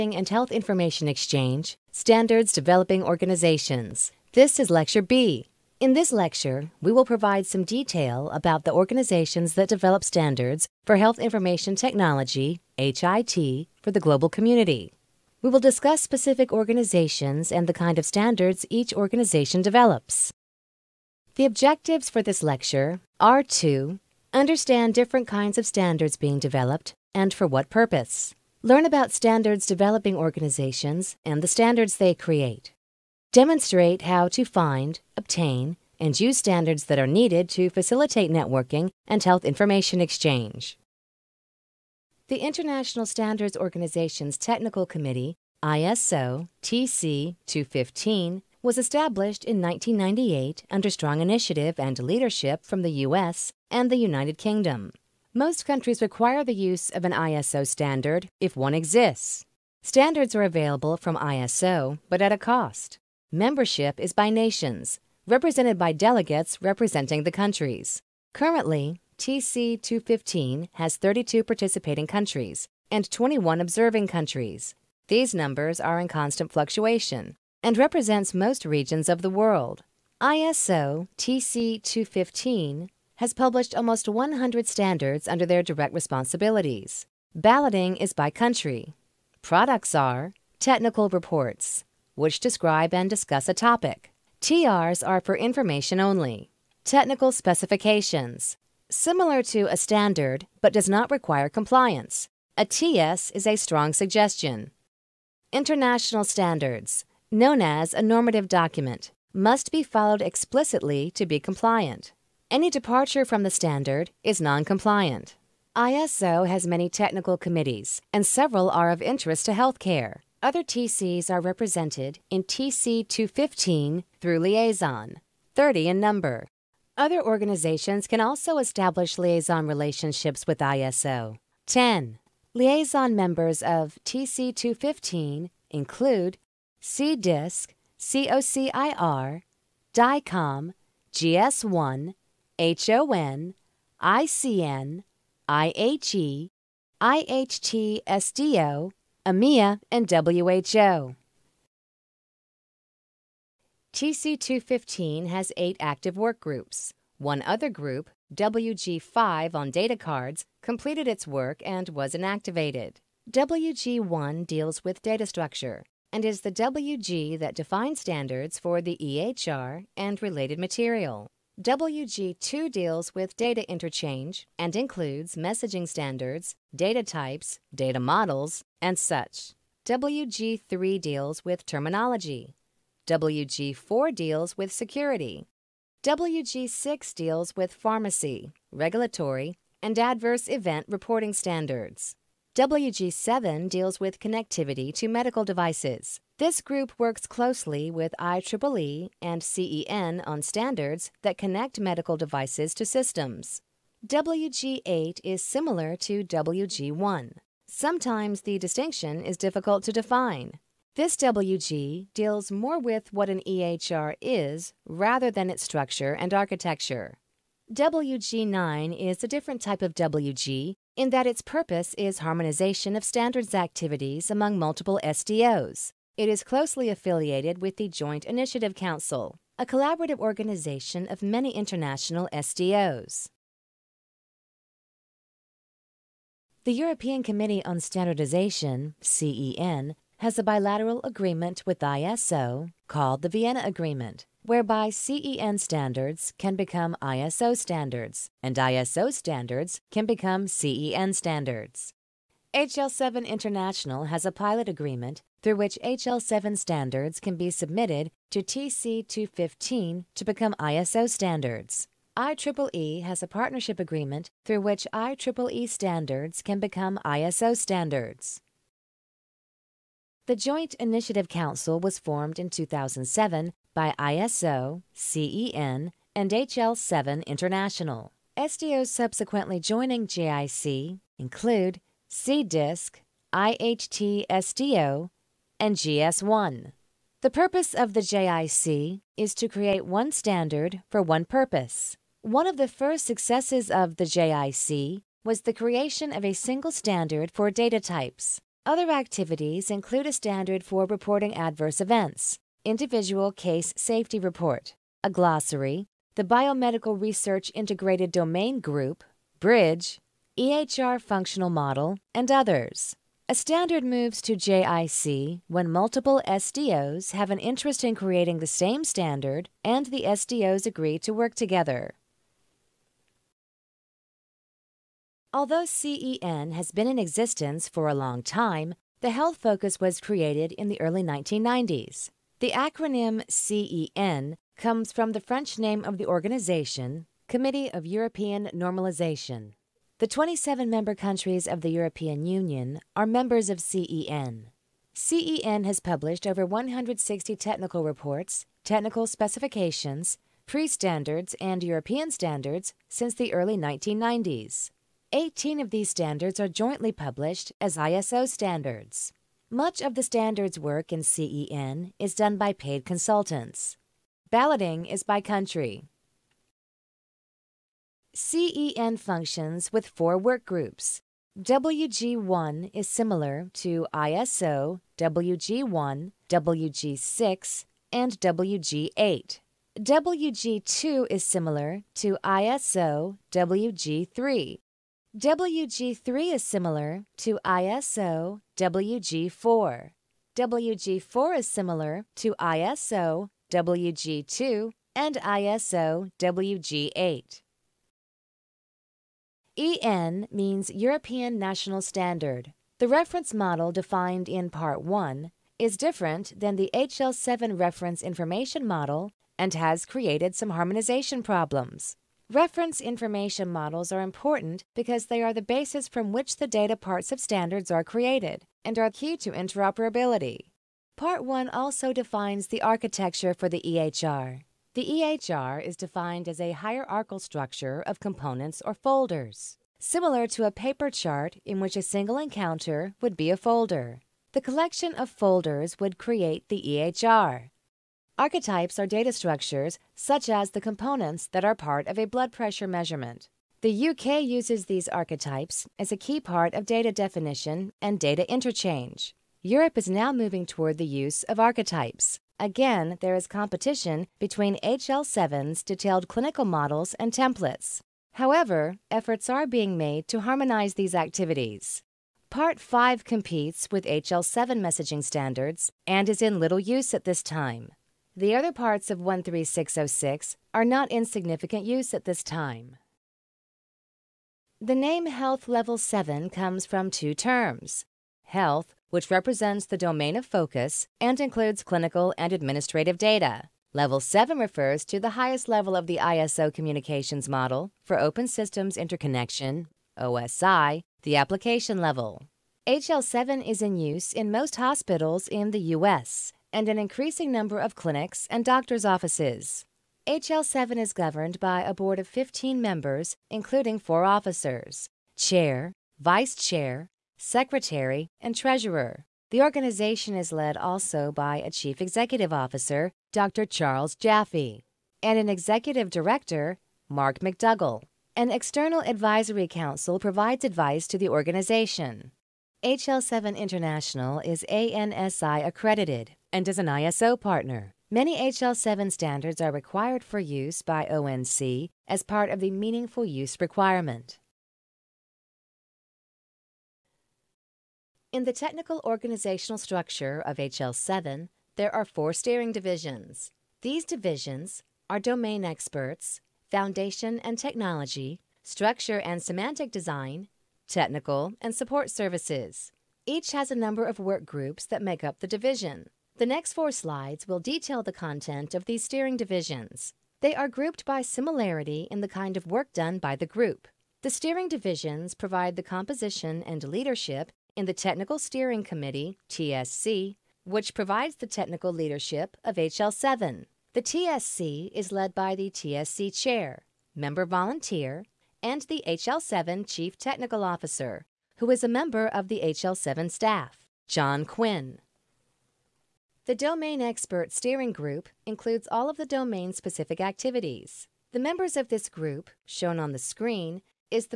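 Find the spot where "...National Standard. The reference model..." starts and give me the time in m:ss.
6:41.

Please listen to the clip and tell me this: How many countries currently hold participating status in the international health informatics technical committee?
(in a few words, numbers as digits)
32.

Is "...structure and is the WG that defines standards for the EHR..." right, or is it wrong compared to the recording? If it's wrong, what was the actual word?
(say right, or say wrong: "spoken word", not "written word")
right.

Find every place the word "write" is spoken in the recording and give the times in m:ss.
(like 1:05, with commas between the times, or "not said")
not said.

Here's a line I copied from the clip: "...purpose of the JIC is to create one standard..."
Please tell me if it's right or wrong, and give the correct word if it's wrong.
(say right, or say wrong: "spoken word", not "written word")
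right.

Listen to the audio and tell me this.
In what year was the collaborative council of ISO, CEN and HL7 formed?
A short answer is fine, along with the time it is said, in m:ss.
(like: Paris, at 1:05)
2007, at 4:32.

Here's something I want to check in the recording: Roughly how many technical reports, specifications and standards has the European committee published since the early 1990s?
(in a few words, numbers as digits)
over 160.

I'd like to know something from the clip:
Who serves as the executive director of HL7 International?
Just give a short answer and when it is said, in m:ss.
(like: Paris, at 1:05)
Mark McDougall, at 8:36.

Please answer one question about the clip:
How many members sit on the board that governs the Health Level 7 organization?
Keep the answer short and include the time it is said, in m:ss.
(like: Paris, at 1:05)
15, at 8:22.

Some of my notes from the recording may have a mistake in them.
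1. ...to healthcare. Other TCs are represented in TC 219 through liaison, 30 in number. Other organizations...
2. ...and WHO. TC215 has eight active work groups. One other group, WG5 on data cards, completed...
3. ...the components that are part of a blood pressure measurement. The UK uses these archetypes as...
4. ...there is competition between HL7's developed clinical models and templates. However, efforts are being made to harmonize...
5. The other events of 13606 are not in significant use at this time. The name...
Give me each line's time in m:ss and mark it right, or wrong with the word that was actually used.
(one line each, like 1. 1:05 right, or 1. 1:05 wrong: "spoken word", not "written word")
1. 1:59 wrong: "215", not "219"
2. 2:29 right
3. 7:20 right
4. 7:32 wrong: "detailed", not "developed"
5. 7:48 wrong: "parts", not "events".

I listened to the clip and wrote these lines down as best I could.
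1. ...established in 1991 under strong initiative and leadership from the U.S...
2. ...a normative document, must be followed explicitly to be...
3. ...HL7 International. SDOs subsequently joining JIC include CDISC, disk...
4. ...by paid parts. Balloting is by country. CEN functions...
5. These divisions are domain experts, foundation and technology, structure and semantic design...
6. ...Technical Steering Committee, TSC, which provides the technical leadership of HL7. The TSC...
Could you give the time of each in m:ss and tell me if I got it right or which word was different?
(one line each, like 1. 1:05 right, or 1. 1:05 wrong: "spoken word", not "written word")
1. 0:48 wrong: "1998", not "1991"
2. 1:47 right
3. 4:36 right
4. 6:02 wrong: "consultants", not "parts"
5. 9:03 right
6. 9:27 right.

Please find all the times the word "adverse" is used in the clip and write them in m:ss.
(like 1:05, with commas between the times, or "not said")
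3:09, 5:01.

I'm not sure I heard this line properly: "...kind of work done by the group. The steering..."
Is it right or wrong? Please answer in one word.
right.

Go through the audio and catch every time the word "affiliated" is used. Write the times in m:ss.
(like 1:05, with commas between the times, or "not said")
3:46.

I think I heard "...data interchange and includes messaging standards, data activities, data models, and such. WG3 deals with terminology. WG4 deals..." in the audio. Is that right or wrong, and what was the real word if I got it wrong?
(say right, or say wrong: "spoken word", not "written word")
wrong: "types", not "activities".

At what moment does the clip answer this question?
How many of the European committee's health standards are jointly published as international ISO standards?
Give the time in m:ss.
5:55.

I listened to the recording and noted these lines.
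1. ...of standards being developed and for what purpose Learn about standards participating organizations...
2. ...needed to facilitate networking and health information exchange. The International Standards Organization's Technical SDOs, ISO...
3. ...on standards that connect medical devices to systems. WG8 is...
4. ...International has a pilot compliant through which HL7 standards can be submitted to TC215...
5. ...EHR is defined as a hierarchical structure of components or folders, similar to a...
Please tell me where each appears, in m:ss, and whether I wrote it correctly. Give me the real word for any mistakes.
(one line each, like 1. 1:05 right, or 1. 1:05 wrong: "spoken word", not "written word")
1. 0:25 wrong: "developing", not "participating"
2. 0:37 wrong: "Committee", not "SDOs"
3. 3:20 right
4. 4:13 wrong: "agreement", not "compliant"
5. 7:04 right.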